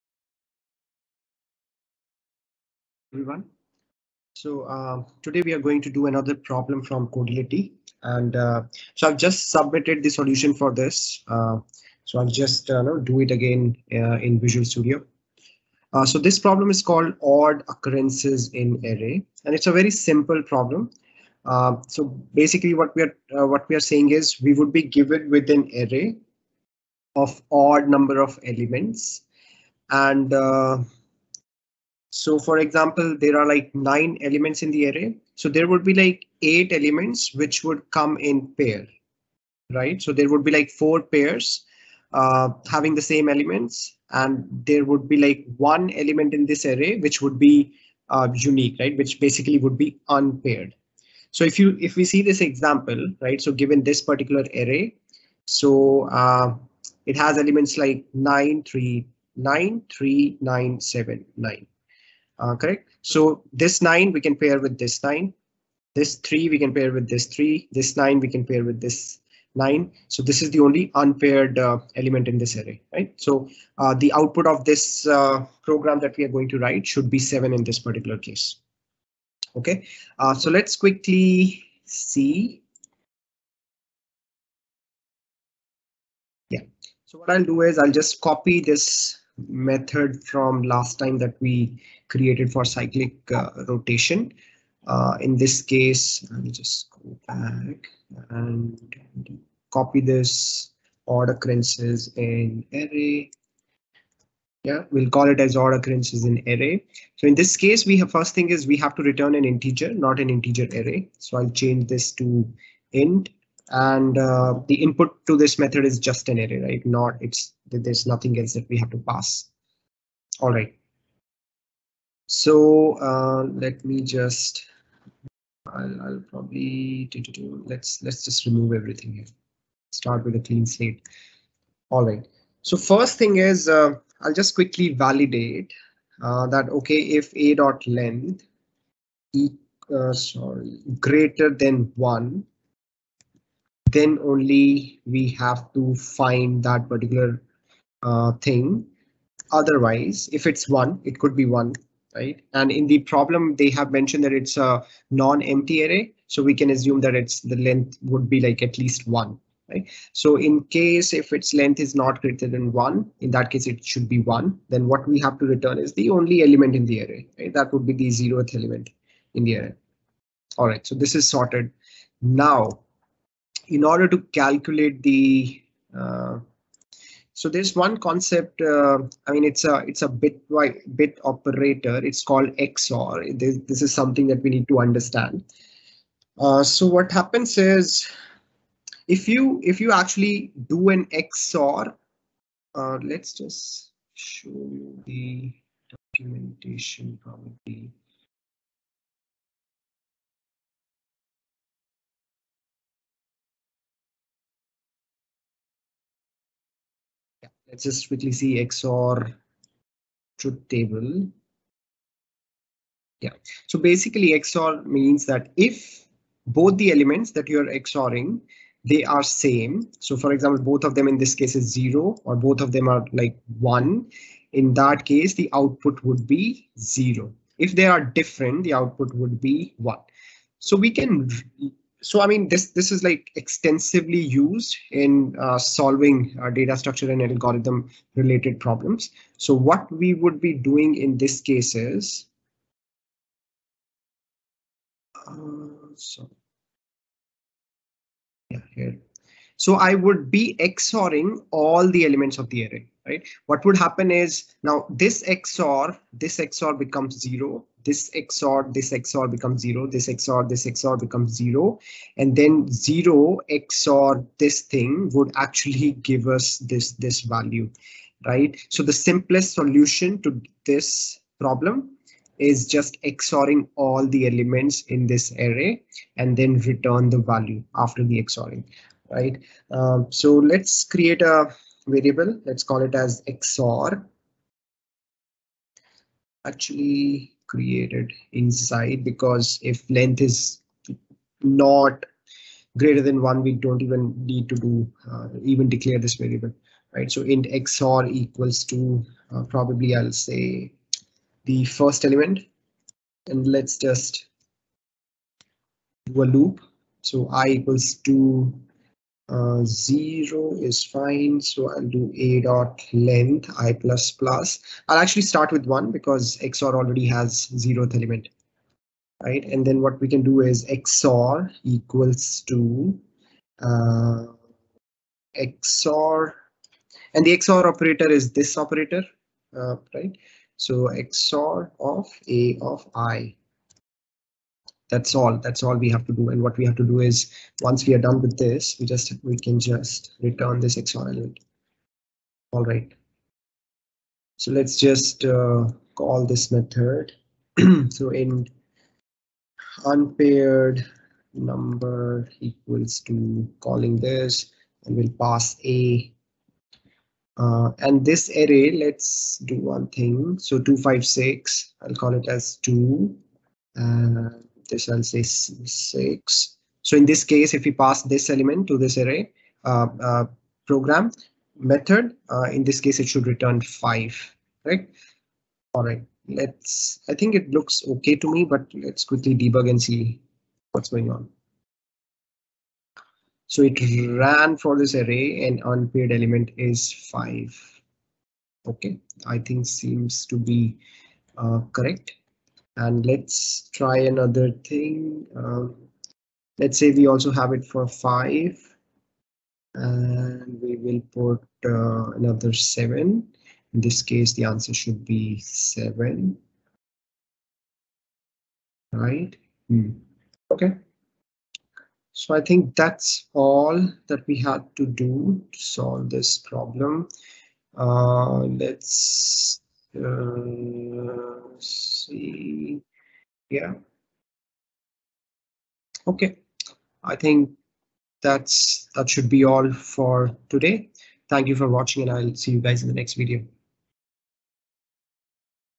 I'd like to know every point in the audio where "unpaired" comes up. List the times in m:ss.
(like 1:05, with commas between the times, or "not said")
0:50, 1:10, 5:49, 6:25.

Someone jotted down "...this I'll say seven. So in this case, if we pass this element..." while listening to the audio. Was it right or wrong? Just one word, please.
wrong.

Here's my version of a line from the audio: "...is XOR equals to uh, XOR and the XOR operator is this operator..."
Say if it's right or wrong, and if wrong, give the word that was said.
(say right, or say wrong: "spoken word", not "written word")
right.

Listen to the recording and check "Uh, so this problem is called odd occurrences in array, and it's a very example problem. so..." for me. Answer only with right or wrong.
wrong.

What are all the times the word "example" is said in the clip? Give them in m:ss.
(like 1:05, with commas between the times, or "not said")
0:32, 0:52, 3:40.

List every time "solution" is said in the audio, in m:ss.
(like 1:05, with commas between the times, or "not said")
0:10, 4:29.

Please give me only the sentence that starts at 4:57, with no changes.
So int xor equals to uh, probably I'll say the first element and let's just do a loop.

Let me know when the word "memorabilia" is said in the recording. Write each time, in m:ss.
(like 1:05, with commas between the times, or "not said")
not said.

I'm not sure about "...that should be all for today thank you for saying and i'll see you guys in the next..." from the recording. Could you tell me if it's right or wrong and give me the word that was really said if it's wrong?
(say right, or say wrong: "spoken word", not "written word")
wrong: "watching", not "saying".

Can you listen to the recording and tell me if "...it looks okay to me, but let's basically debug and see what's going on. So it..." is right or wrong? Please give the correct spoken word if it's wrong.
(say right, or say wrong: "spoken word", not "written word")
wrong: "quickly", not "basically".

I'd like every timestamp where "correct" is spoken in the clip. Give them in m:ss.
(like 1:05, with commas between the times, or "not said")
1:02, 6:31.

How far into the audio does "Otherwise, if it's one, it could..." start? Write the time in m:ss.
2:29.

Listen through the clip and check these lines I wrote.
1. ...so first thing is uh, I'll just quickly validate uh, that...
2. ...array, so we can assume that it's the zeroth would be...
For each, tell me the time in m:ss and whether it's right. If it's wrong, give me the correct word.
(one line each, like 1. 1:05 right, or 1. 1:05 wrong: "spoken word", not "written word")
1. 2:12 right
2. 2:35 wrong: "length", not "zeroth".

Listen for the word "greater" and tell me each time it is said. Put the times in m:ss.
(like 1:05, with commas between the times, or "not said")
2:20, 2:42, 4:52.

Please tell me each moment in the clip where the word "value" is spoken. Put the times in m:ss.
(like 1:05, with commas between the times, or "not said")
4:27, 4:37.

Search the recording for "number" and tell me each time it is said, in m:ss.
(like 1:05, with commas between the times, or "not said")
0:27, 5:51.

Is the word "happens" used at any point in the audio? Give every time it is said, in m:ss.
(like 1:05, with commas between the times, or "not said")
3:07, 4:13.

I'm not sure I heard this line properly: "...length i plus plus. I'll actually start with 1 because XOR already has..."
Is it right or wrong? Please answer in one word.
right.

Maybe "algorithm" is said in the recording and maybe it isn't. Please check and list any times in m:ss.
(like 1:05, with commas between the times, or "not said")
3:57.